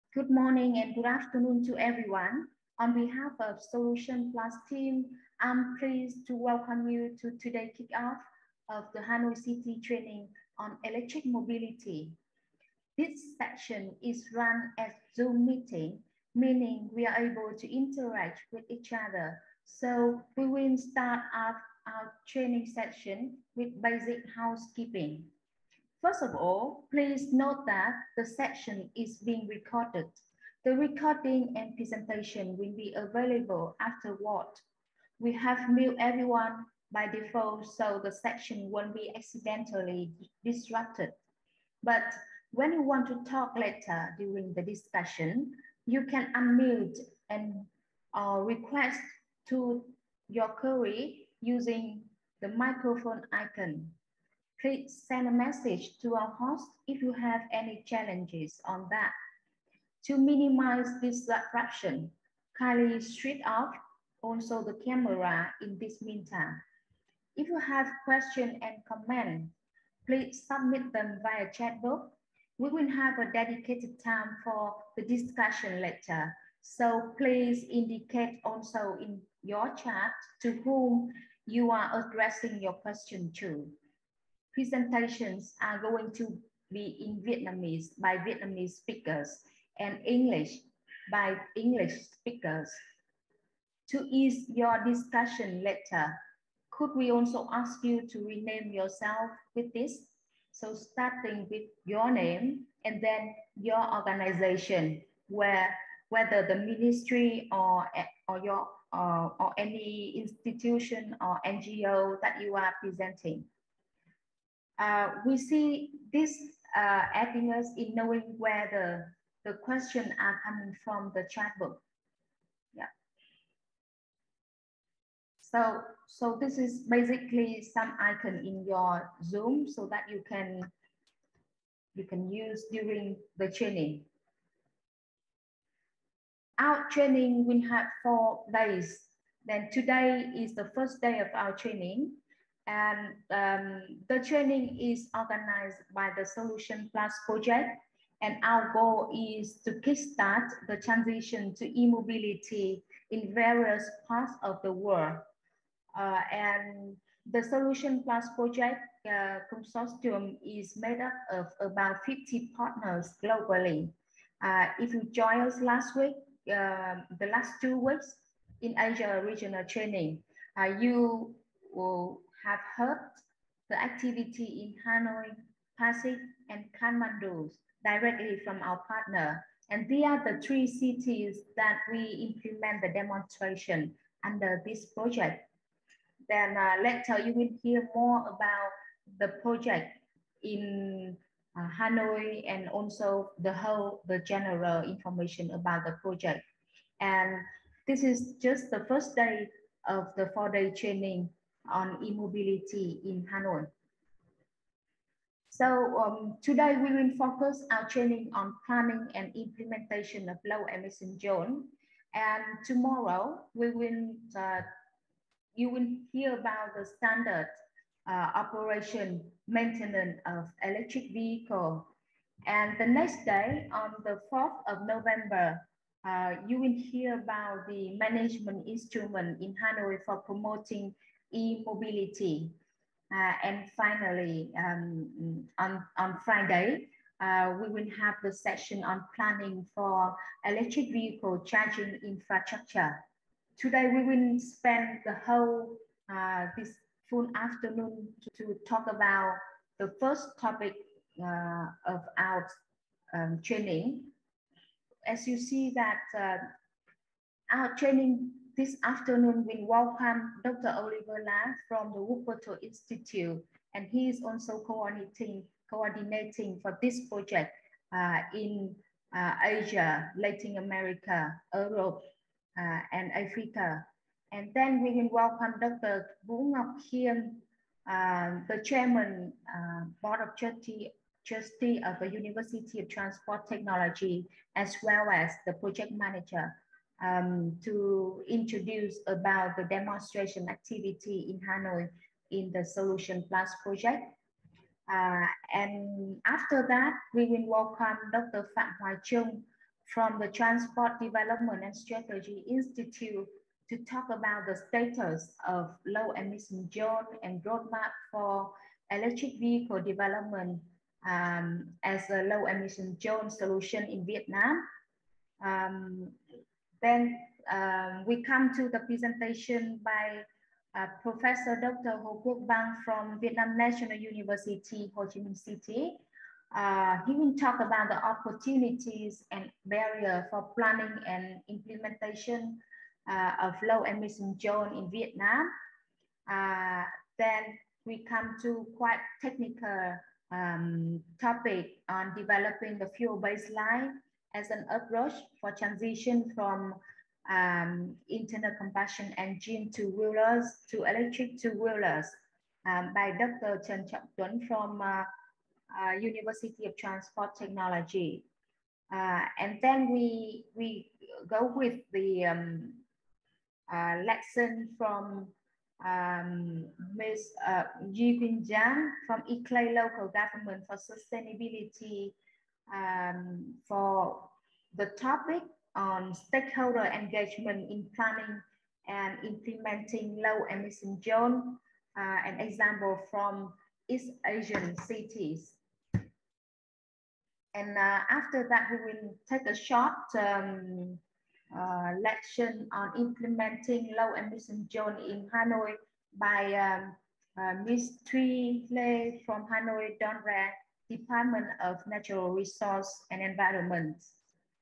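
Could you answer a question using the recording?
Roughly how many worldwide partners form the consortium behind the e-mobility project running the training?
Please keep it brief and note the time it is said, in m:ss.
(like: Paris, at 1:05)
50, at 2:41.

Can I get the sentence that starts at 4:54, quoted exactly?
Uh, and after that, we will welcome Dr.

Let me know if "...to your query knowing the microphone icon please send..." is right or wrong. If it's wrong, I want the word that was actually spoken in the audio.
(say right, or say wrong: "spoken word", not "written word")
wrong: "using", not "knowing".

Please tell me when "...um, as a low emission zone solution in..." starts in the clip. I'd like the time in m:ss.
5:11.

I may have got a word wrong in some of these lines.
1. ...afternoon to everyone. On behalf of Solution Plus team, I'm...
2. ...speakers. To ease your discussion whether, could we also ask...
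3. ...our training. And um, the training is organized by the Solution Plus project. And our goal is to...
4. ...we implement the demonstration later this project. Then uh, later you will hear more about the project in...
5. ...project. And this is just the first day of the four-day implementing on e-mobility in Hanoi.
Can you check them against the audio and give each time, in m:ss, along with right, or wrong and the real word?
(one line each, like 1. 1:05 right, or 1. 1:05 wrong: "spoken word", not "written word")
1. 0:01 right
2. 1:32 wrong: "later", not "whether"
3. 2:21 right
4. 3:01 wrong: "under", not "later"
5. 3:16 wrong: "training", not "implementing".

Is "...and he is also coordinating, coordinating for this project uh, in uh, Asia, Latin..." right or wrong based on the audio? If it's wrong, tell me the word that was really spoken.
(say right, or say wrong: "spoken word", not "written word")
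right.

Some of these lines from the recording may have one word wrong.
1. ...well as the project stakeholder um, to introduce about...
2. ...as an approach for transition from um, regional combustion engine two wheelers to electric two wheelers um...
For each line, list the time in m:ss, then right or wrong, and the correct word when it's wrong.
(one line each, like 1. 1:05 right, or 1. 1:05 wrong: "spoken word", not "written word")
1. 4:44 wrong: "manager", not "stakeholder"
2. 5:44 wrong: "internal", not "regional".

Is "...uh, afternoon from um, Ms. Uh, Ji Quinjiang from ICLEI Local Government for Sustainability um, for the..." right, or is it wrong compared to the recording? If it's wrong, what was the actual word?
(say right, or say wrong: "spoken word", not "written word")
wrong: "lesson", not "afternoon".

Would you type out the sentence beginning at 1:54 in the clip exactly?
Uh, we see this uh, happiness in knowing where the, the questions are coming from the chat book.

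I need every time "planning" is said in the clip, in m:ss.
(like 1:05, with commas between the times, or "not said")
3:28, 3:59, 5:30, 6:17.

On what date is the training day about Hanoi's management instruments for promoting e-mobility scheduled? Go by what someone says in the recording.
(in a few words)
4 November.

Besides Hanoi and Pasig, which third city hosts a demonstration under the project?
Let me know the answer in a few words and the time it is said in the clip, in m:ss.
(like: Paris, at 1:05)
Kathmandu, at 2:56.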